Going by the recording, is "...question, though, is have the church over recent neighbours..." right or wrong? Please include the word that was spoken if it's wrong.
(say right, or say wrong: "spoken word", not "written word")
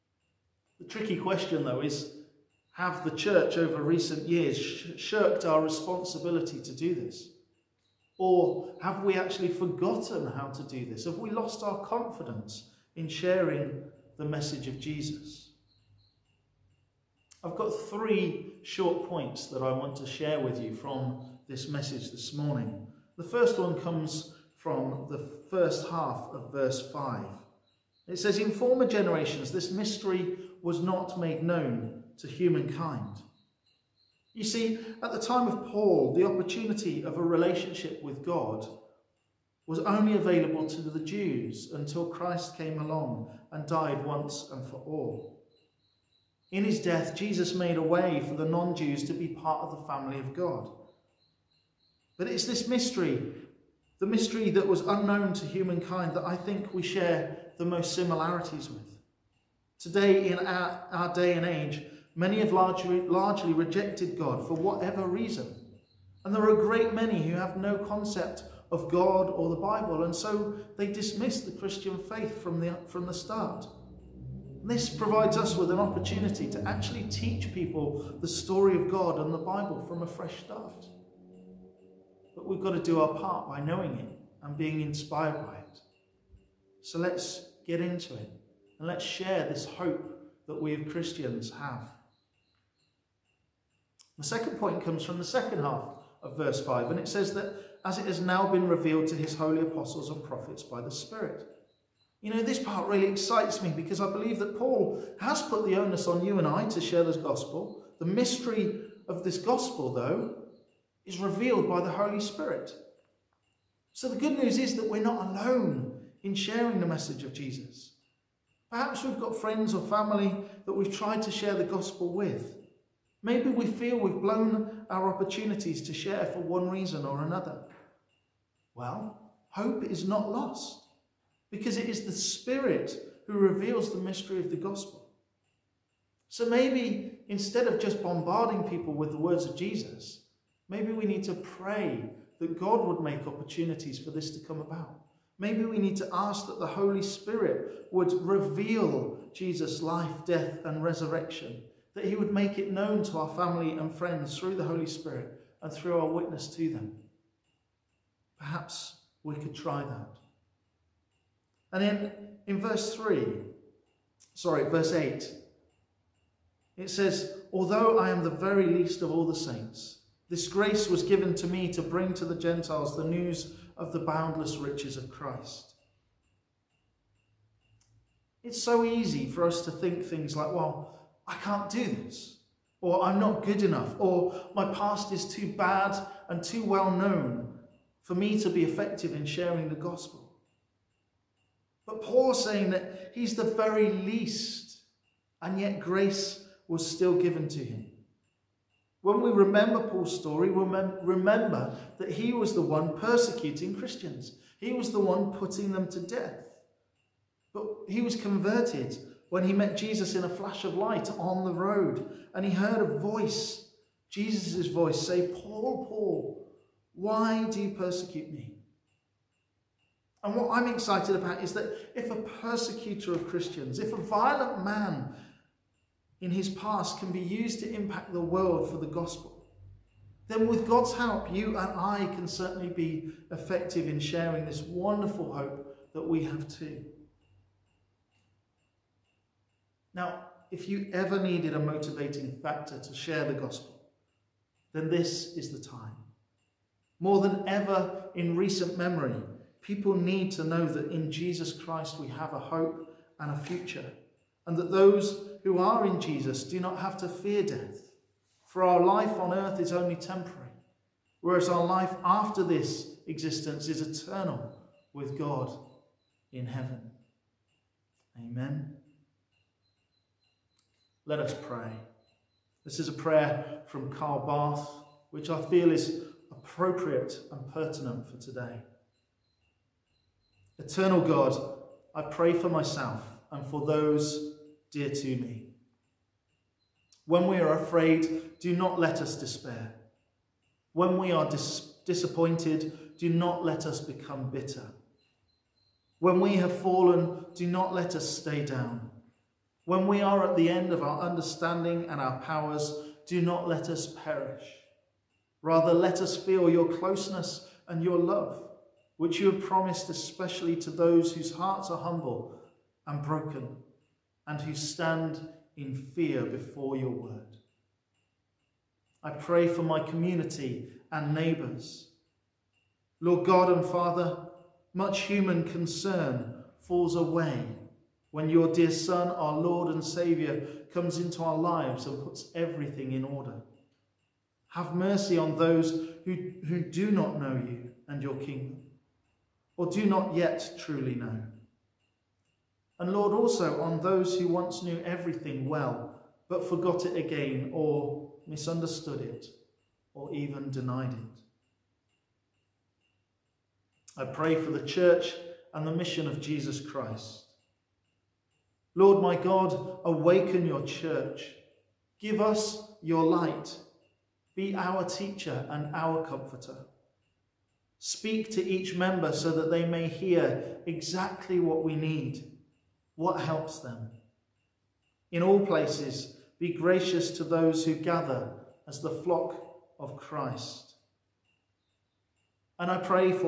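wrong: "years", not "neighbours".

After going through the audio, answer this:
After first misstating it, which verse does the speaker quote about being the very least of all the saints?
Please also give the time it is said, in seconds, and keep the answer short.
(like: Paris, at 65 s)
Verse 8, at 164 s.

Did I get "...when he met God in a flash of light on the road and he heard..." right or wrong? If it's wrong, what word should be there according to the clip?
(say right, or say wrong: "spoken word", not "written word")
wrong: "Jesus", not "God".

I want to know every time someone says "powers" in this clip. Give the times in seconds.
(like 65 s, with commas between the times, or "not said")
302 s.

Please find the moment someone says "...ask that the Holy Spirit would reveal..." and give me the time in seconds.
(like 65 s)
146 s.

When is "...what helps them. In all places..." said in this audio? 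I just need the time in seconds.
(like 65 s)
372 s.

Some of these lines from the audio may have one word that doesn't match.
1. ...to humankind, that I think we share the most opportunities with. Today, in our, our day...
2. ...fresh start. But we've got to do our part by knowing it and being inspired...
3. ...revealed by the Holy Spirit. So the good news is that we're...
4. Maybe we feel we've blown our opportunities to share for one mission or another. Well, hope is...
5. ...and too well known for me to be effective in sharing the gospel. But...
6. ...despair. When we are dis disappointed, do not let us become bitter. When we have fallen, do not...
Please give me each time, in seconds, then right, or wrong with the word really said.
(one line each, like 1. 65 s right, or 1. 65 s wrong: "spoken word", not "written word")
1. 55 s wrong: "similarities", not "opportunities"
2. 80 s right
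3. 111 s right
4. 123 s wrong: "reason", not "mission"
5. 186 s right
6. 289 s right.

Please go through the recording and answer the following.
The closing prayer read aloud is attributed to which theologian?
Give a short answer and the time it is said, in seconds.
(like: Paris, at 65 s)
Karl Barth, at 273 s.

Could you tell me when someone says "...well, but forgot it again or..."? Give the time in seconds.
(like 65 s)
345 s.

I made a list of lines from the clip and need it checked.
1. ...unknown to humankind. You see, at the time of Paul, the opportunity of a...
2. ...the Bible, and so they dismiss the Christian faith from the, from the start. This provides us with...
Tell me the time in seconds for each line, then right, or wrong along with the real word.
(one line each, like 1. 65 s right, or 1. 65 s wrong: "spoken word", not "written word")
1. 31 s wrong: "known", not "unknown"
2. 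69 s right.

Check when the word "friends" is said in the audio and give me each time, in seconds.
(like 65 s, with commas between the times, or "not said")
119 s, 153 s.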